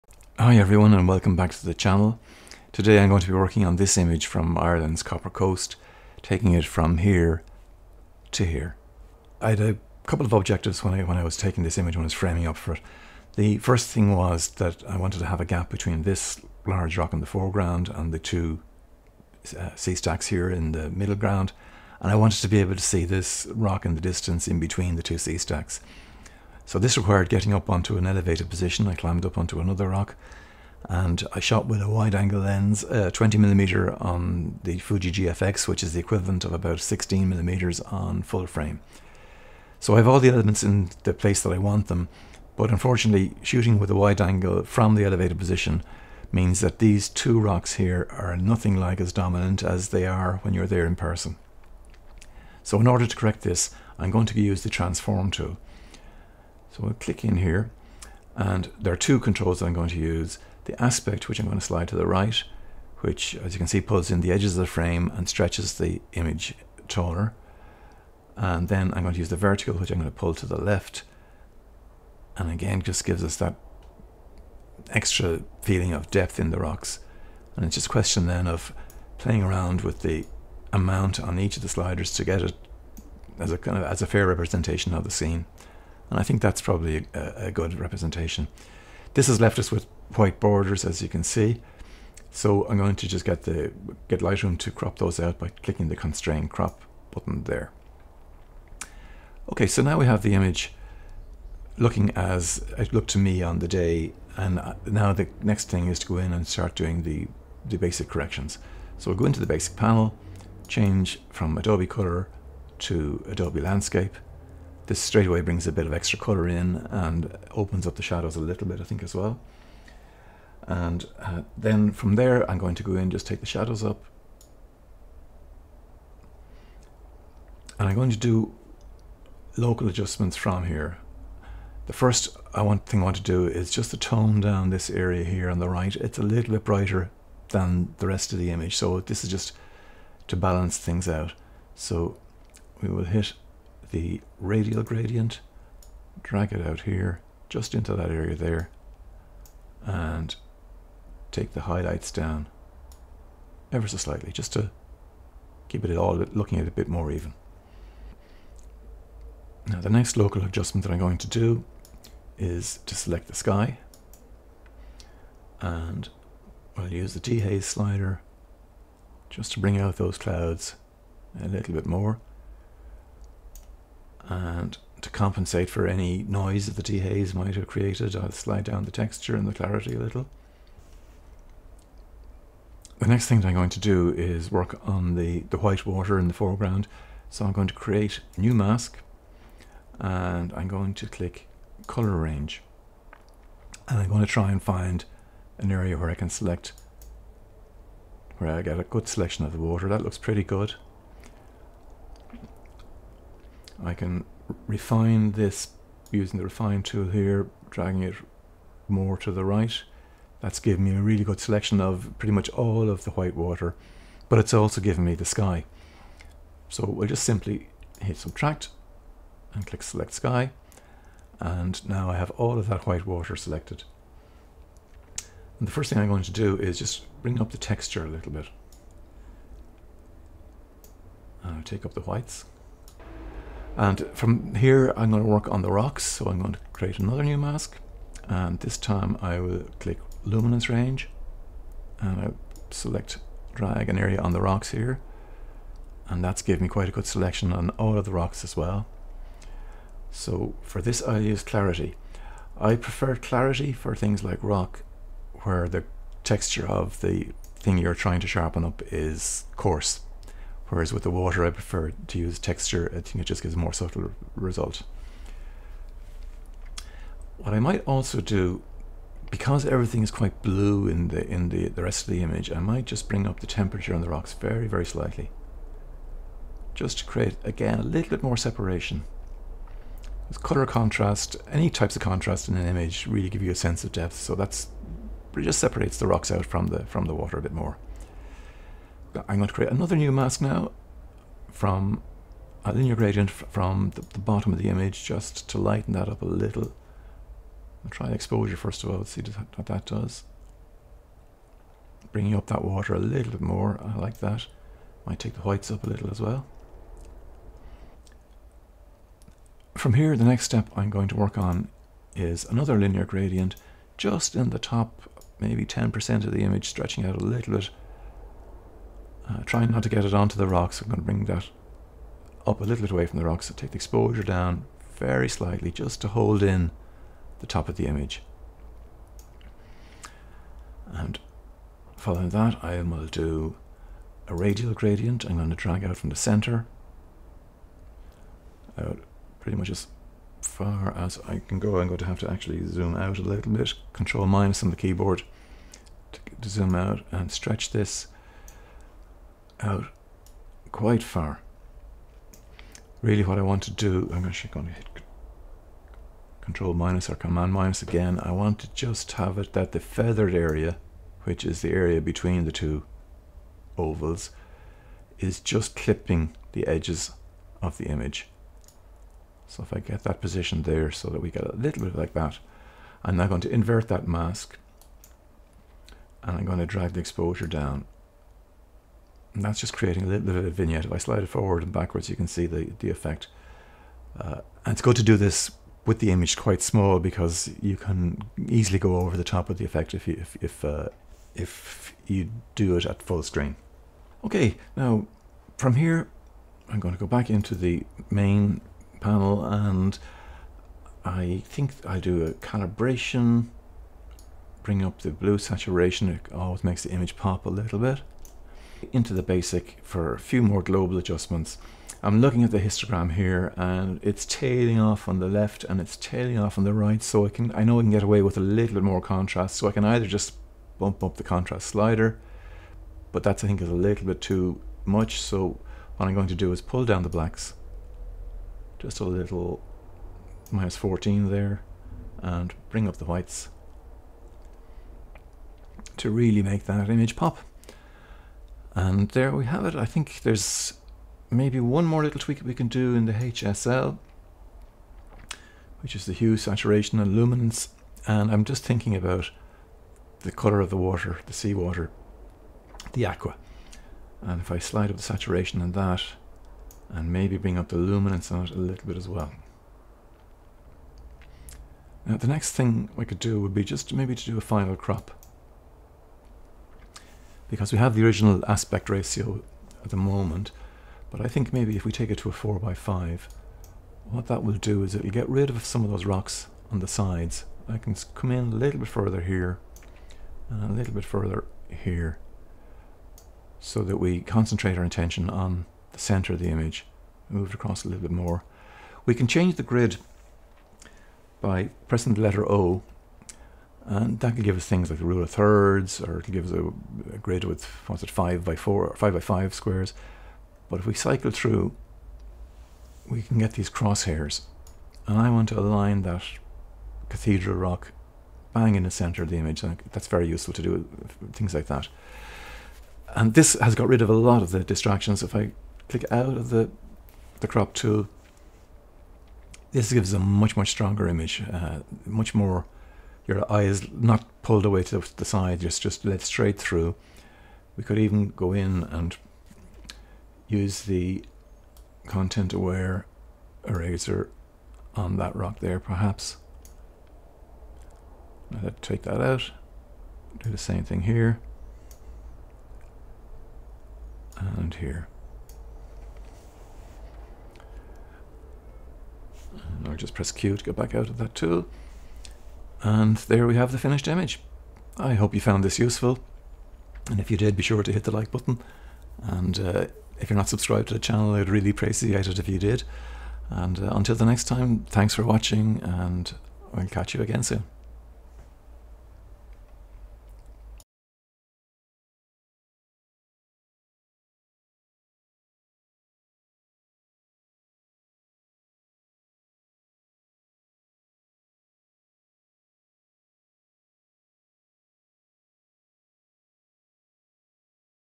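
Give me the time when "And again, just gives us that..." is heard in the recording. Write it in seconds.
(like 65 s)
72 s.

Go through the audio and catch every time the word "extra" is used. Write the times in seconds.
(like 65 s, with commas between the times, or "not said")
74 s, 115 s.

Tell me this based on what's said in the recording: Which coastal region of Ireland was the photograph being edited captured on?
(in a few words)
Copper Coast.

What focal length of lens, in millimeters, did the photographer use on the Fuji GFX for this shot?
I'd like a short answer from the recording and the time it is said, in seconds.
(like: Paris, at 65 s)
20 millimeter, at 33 s.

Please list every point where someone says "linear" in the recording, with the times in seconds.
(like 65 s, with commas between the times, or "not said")
292 s, 312 s.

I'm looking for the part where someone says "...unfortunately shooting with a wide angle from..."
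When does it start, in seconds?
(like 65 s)
42 s.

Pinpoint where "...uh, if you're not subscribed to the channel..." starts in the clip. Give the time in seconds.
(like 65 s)
559 s.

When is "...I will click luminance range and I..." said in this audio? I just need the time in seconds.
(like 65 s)
239 s.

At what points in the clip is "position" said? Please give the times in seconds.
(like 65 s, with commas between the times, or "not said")
28 s, 45 s, 370 s.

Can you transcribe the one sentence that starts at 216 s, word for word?
So we'll just simply hit subtract and click select sky.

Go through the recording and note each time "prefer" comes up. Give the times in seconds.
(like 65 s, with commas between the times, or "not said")
252 s, 261 s.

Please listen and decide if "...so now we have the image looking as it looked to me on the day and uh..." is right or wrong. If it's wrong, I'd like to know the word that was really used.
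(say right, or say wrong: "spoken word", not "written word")
right.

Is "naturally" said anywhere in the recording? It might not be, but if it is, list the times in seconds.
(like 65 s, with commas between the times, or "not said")
not said.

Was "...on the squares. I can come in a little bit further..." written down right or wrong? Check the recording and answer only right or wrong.
wrong.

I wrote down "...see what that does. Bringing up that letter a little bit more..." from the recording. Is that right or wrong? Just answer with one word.
wrong.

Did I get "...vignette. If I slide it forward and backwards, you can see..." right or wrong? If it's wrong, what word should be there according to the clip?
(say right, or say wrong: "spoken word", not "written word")
right.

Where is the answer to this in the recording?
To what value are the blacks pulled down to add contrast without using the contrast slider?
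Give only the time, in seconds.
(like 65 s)
430 s.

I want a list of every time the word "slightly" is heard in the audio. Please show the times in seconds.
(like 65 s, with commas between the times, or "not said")
153 s, 274 s, 325 s.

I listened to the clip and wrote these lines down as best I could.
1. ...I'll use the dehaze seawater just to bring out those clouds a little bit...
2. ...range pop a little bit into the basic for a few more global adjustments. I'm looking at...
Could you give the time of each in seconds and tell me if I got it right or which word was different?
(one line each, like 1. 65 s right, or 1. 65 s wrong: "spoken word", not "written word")
1. 166 s wrong: "slider", not "seawater"
2. 406 s wrong: "image", not "range".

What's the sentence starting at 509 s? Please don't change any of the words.
That's very useful to do things like that.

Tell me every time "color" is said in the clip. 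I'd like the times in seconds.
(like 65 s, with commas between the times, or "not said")
111 s, 116 s, 191 s, 280 s, 450 s.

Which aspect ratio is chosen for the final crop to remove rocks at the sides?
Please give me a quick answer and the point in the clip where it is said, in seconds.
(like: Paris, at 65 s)
4 by 5, at 472 s.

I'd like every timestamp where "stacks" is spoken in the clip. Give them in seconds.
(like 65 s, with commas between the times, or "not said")
19 s, 25 s.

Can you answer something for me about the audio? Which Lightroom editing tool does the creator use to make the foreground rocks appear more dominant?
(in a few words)
transform tool.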